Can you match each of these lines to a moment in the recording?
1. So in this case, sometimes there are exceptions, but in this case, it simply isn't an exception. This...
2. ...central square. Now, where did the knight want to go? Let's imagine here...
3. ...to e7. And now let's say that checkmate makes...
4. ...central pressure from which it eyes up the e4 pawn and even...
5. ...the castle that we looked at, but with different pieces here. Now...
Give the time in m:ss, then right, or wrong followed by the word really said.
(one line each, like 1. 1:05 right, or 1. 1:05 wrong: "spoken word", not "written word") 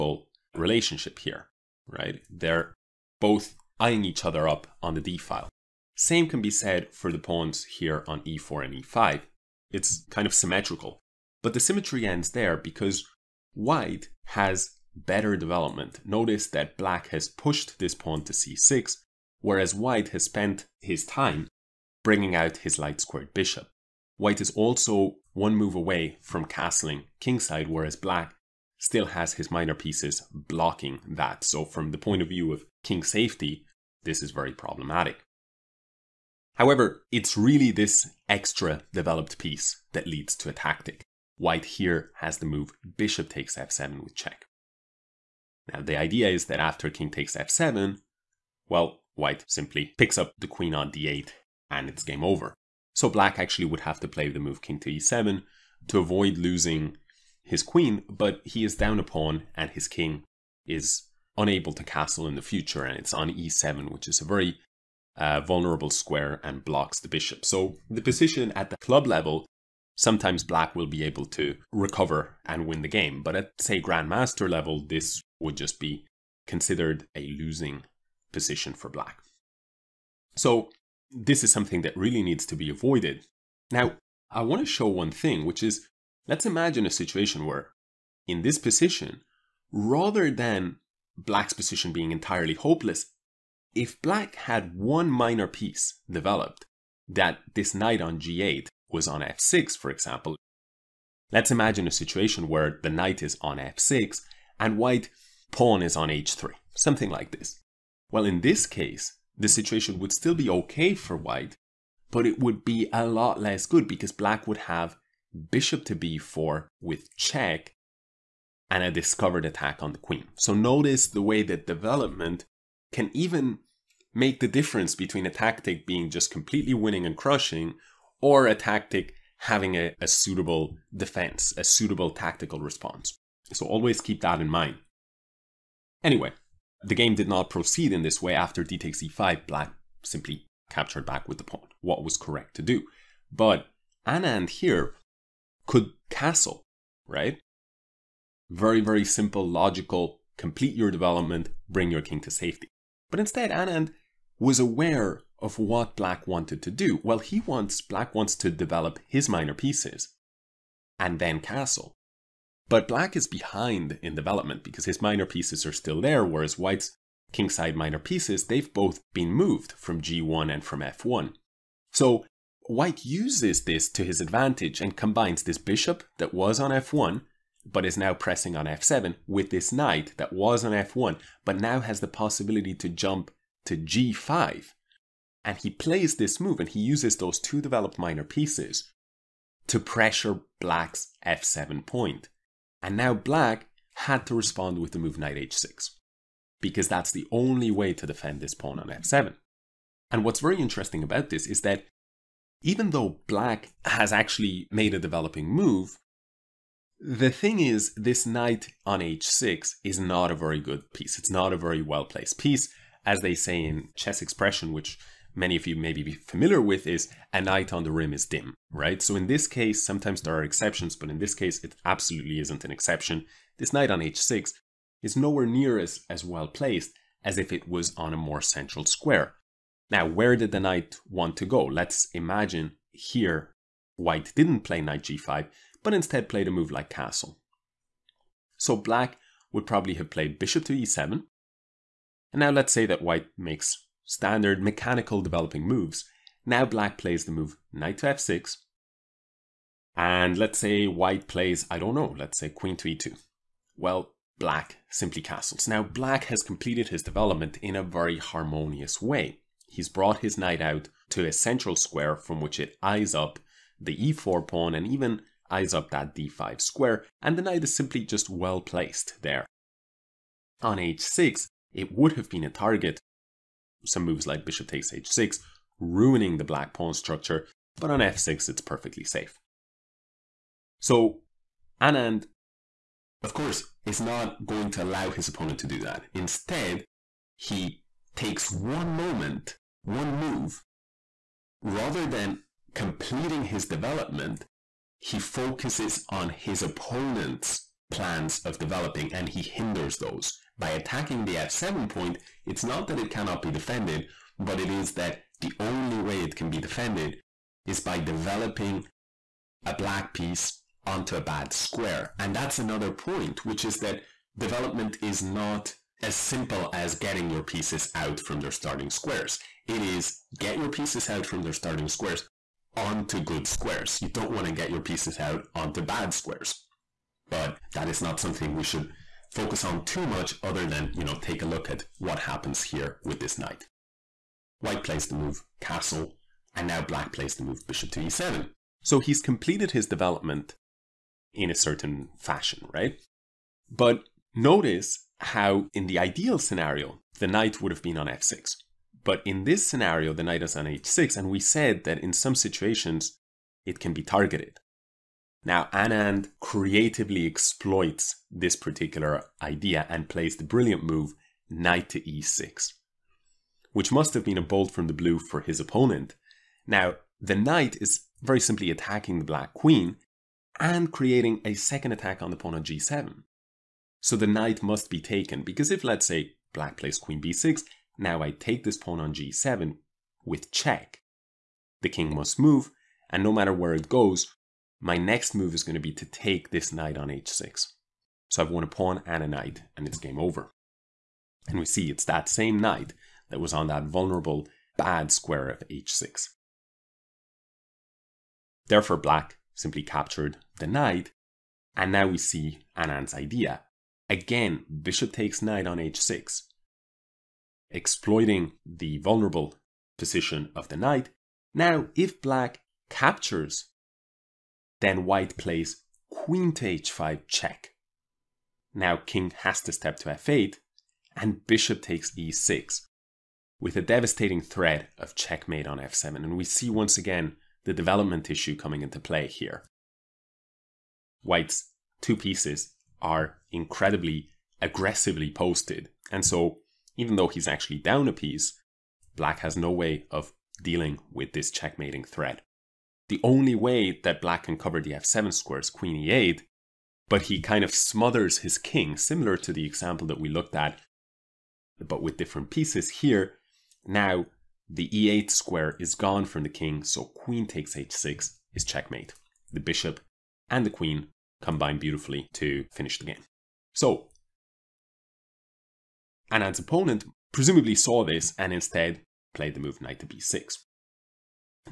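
1. 3:39 wrong: "absolutely", not "simply"
2. 3:48 right
3. 4:00 wrong: "white", not "checkmate"
4. 4:21 wrong: "square", not "pressure"
5. 7:29 wrong: "example", not "castle".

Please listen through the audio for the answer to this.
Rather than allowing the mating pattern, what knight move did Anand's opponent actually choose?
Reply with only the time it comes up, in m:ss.
7:49.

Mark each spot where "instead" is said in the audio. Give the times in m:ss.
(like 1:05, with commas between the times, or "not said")
2:33, 3:55, 4:46, 7:48.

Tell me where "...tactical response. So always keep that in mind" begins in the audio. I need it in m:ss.
2:12.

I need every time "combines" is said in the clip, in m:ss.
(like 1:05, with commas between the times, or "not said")
2:54, 7:41.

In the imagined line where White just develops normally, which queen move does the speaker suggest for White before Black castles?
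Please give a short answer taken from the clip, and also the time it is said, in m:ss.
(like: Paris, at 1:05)
Queen to e2, at 4:12.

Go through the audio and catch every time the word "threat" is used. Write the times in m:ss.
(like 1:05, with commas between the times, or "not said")
7:04, 7:22.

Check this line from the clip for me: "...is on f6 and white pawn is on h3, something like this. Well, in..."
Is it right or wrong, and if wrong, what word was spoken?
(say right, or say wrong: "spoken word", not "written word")
right.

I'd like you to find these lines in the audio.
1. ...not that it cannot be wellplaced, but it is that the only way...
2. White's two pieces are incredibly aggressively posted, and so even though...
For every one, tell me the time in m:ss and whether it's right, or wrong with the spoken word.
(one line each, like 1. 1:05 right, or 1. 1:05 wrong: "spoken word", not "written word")
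1. 5:02 wrong: "defended", not "wellplaced"
2. 7:11 right.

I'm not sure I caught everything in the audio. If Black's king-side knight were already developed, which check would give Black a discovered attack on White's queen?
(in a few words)
Bishop to b4.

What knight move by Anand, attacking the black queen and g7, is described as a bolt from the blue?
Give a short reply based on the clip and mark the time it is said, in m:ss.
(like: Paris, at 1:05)
Knight to e6, at 6:01.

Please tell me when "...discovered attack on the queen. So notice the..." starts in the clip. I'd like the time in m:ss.
1:58.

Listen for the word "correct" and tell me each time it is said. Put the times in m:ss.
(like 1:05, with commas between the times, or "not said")
2:22.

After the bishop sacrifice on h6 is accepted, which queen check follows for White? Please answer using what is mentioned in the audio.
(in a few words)
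Queen to h5.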